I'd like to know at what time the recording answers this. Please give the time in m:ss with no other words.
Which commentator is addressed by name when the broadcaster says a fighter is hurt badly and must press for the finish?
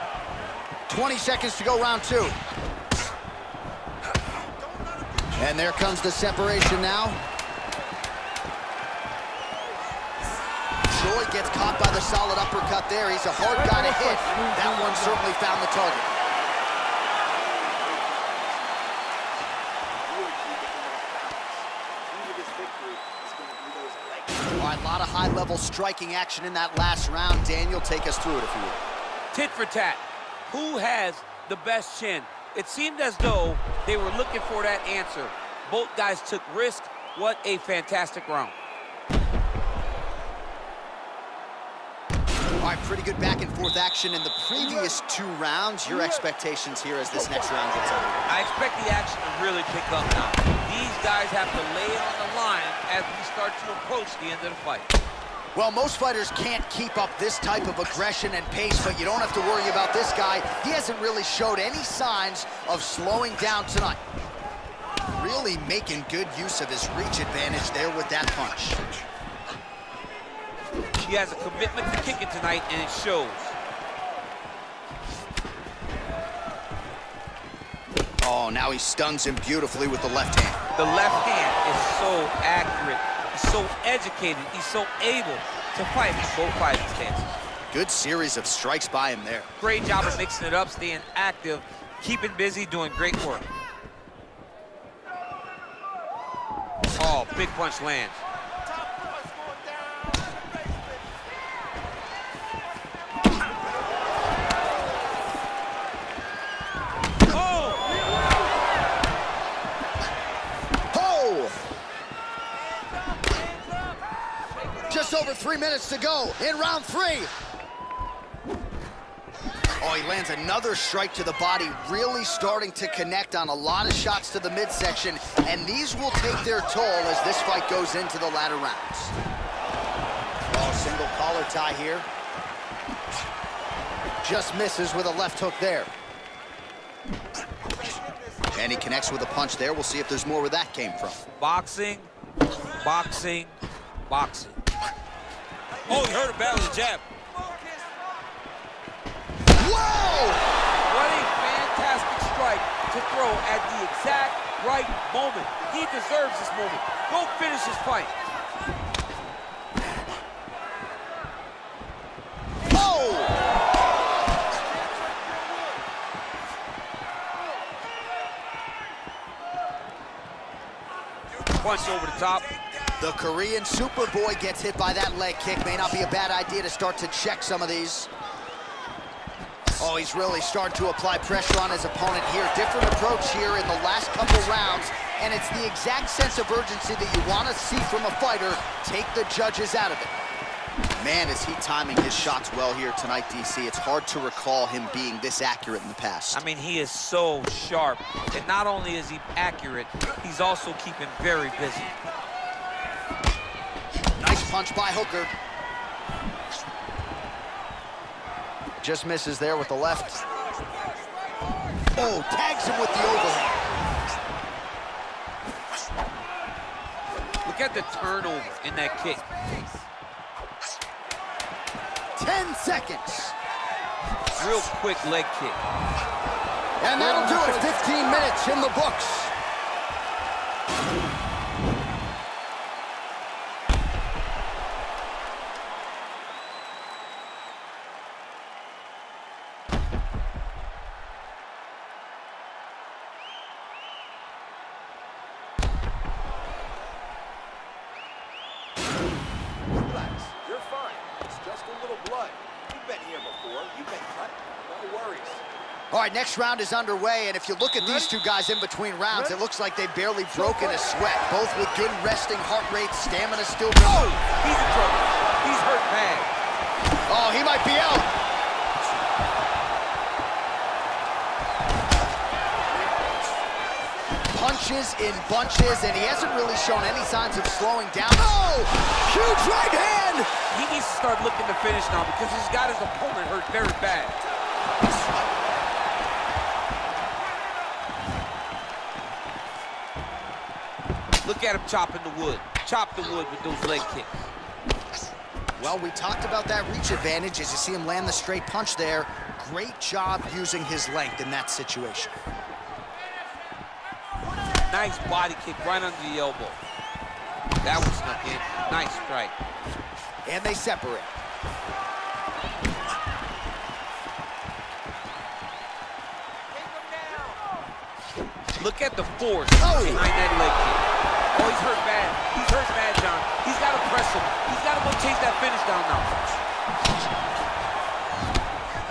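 5:22.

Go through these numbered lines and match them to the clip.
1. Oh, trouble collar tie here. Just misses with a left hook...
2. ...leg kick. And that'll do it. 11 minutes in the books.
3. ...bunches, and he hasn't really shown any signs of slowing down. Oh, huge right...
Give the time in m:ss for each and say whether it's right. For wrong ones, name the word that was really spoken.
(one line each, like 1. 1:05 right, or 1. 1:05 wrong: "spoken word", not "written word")
1. 2:10 wrong: "single", not "trouble"
2. 3:45 wrong: "15", not "11"
3. 4:35 right.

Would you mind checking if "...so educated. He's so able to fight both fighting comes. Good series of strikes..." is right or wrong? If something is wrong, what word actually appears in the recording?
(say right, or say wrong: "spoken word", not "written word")
wrong: "stances", not "comes".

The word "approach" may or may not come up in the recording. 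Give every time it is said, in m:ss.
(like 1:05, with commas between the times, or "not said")
0:53, 3:02.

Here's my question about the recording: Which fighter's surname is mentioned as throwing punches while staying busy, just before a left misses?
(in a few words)
Hooker.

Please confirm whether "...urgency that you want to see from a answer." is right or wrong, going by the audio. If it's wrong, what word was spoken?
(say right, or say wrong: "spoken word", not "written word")
wrong: "fighter", not "answer".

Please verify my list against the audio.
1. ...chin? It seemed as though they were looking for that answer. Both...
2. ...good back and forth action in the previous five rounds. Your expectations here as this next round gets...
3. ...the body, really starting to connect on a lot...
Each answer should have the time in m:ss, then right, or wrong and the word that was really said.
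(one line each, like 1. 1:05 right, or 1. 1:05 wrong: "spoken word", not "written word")
1. 0:31 right
2. 0:43 wrong: "two", not "five"
3. 2:01 right.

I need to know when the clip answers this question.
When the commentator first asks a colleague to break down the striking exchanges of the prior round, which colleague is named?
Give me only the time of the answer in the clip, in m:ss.
0:27.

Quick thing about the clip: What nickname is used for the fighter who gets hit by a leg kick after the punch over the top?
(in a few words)
The Korean Superboy.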